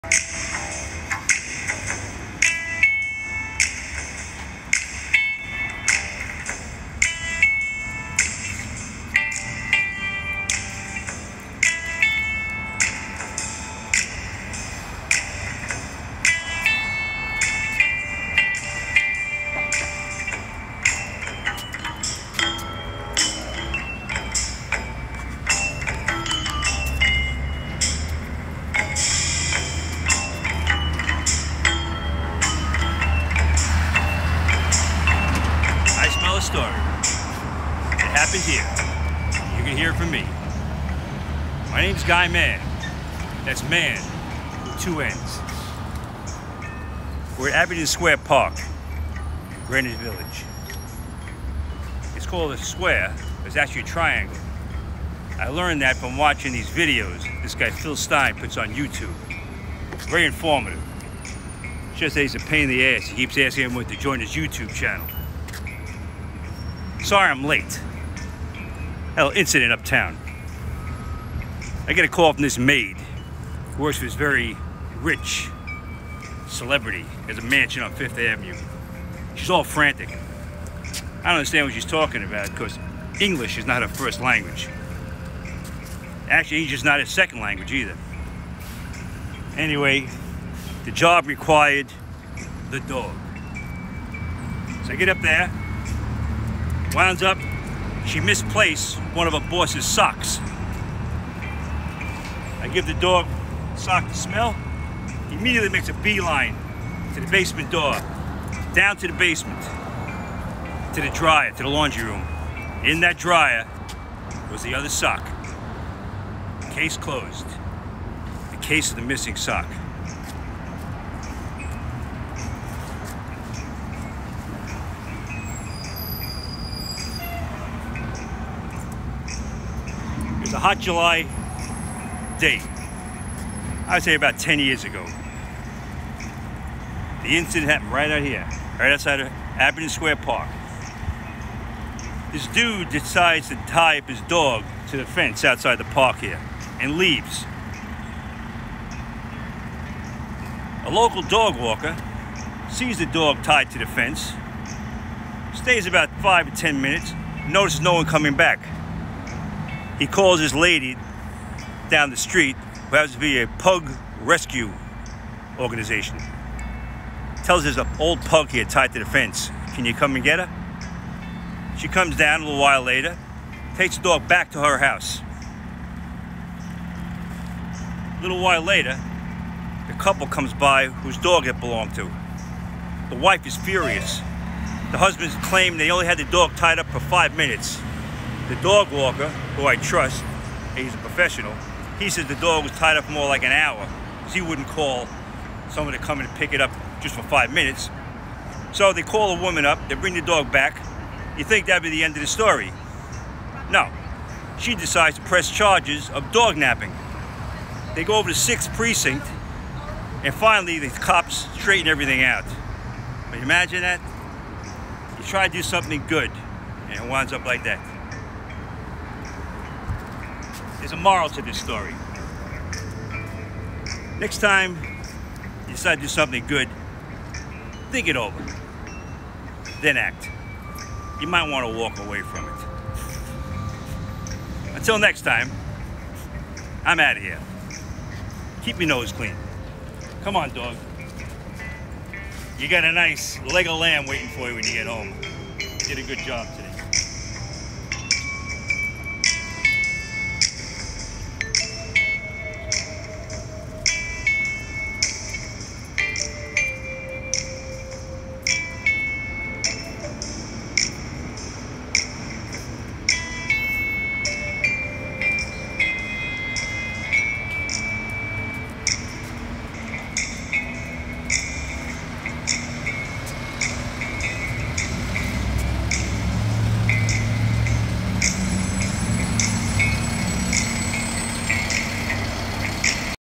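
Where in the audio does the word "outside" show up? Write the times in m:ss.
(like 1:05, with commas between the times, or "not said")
2:18, 2:25.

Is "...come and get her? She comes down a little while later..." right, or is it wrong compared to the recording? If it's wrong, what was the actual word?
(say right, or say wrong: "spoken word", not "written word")
right.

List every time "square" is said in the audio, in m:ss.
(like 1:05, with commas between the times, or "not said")
0:47, 0:52, 2:19.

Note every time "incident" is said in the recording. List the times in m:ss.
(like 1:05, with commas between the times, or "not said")
1:09, 2:17.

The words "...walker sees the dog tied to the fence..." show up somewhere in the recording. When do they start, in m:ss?
2:31.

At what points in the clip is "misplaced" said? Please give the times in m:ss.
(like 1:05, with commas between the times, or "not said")
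1:38.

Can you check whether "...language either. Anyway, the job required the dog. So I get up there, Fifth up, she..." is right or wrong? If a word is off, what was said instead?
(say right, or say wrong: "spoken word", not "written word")
wrong: "Winds", not "Fifth".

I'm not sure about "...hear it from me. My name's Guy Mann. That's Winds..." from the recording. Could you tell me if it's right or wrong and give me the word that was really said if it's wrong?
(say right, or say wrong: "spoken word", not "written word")
wrong: "Mann", not "Winds".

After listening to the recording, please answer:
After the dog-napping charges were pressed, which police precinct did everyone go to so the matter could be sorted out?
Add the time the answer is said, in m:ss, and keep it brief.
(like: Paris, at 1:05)
6th Precinct, at 3:28.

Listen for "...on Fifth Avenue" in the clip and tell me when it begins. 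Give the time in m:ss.
1:17.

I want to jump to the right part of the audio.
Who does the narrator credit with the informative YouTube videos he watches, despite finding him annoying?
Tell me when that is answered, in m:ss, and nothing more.
0:57.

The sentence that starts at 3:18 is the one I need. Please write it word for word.
So they call a woman up, they bring the dog back.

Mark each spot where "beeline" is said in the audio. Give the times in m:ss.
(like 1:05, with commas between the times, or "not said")
1:45.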